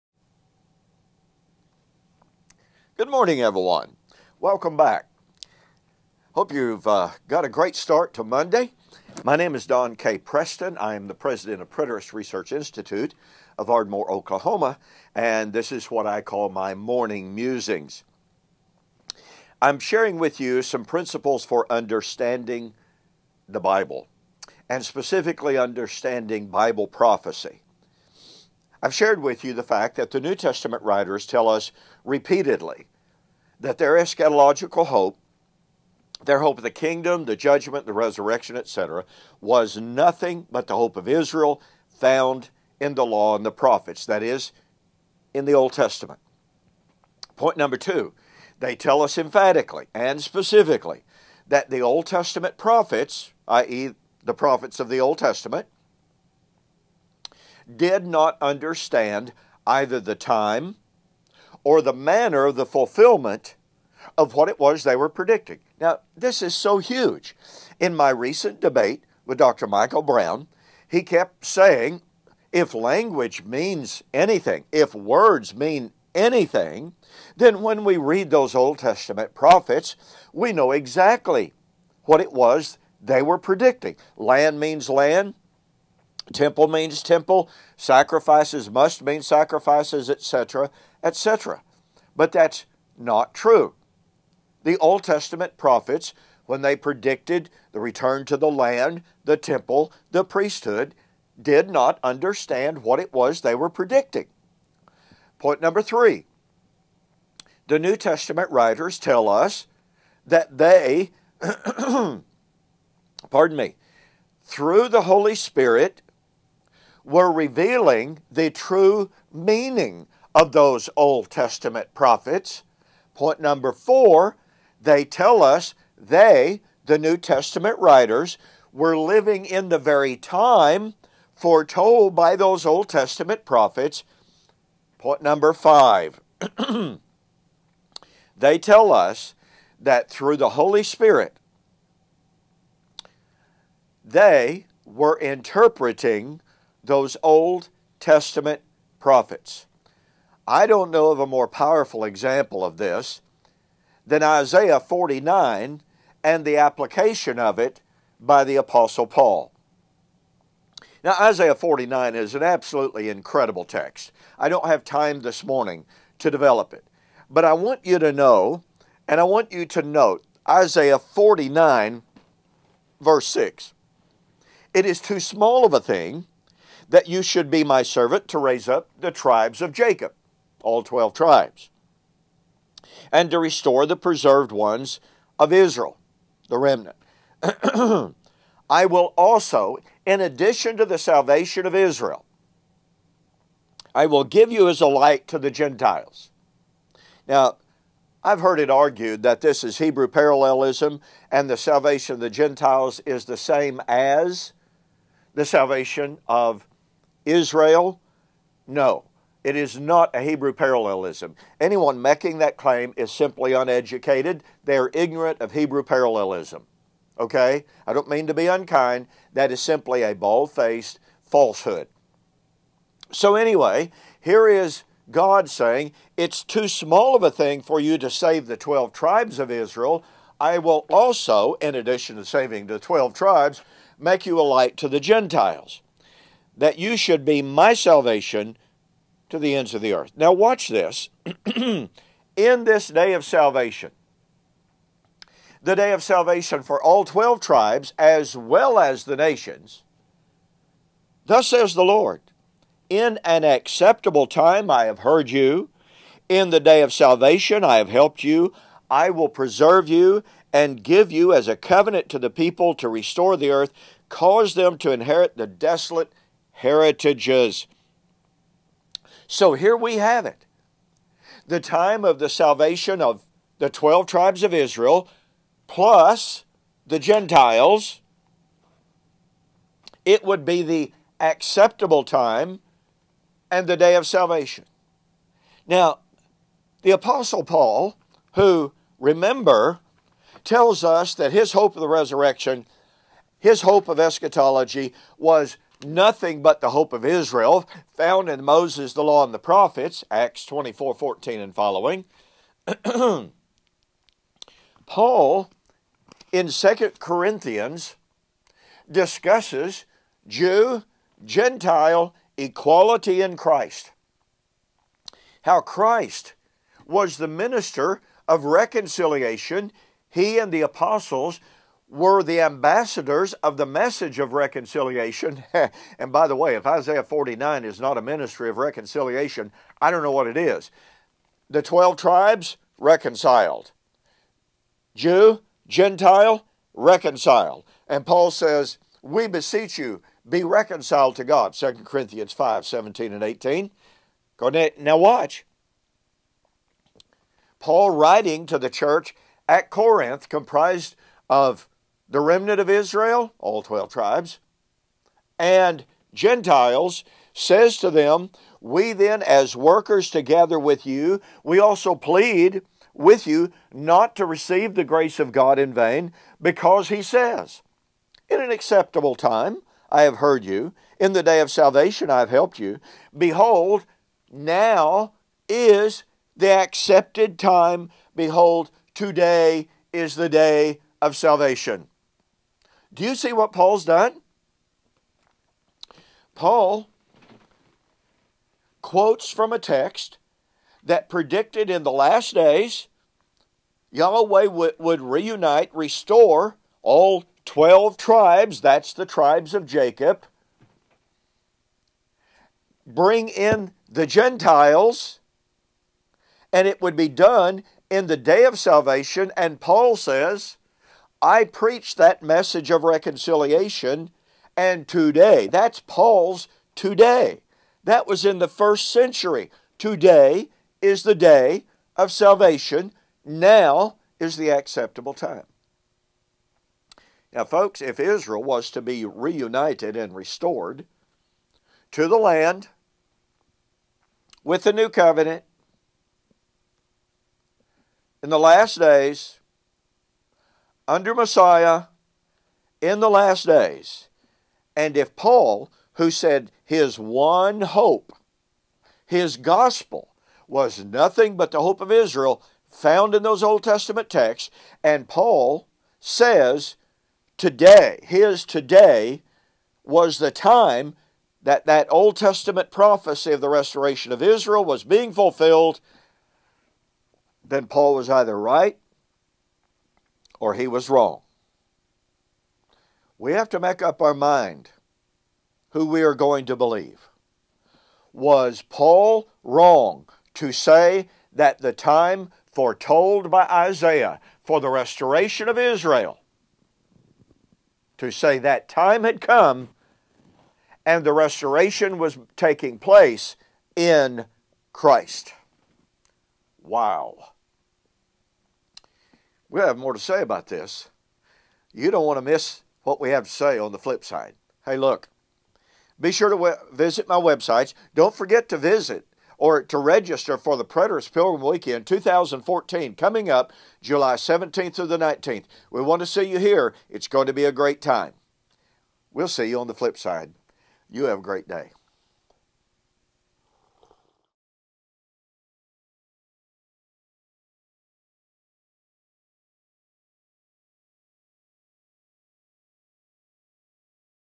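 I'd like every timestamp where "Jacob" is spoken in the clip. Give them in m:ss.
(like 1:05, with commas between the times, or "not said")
2:59, 6:39.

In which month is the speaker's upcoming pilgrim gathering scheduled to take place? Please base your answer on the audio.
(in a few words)
July.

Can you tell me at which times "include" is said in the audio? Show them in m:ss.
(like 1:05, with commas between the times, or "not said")
not said.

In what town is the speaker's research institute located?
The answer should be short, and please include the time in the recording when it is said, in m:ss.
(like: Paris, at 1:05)
Ardmore, Oklahoma, at 0:13.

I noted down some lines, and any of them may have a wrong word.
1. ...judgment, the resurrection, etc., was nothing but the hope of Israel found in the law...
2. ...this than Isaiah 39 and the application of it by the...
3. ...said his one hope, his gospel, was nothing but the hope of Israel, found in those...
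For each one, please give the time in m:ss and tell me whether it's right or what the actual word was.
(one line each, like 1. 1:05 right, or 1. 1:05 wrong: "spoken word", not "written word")
1. 0:37 right
2. 2:32 wrong: "49", not "39"
3. 7:26 right.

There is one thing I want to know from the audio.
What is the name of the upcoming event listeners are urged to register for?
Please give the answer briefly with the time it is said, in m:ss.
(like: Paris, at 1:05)
Preterist Pilgrim Weekend 2014, at 8:30.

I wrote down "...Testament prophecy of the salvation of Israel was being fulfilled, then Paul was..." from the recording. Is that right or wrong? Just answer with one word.
wrong.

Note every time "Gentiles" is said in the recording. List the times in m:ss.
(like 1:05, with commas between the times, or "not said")
3:15, 3:22, 3:54, 4:36, 5:11, 5:35, 5:56, 6:44.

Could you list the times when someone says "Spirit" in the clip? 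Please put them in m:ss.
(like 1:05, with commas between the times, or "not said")
1:55, 2:20.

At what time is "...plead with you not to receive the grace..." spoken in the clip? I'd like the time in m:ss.
6:01.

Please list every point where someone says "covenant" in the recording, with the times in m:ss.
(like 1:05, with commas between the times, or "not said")
4:21, 7:14.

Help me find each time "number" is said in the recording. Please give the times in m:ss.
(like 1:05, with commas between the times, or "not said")
0:47, 1:45, 2:03, 2:15.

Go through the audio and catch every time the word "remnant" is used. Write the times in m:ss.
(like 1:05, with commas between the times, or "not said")
3:06, 5:52.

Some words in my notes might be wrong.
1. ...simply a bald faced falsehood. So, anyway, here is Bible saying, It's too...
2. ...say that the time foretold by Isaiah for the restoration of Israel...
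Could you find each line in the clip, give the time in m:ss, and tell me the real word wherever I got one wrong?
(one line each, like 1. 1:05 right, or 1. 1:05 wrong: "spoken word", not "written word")
1. 3:39 wrong: "God", not "Bible"
2. 8:00 right.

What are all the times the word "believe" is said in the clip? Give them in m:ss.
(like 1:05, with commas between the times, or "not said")
7:56.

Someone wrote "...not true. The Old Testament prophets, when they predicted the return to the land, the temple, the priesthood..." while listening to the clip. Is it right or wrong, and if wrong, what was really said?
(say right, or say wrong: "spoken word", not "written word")
right.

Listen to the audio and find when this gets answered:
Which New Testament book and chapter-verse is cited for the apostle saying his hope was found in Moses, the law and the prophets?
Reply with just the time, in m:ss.
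5:00.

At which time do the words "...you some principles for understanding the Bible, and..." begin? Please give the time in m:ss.
0:20.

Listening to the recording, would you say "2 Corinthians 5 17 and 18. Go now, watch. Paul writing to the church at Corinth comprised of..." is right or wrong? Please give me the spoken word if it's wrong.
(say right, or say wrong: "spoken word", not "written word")
right.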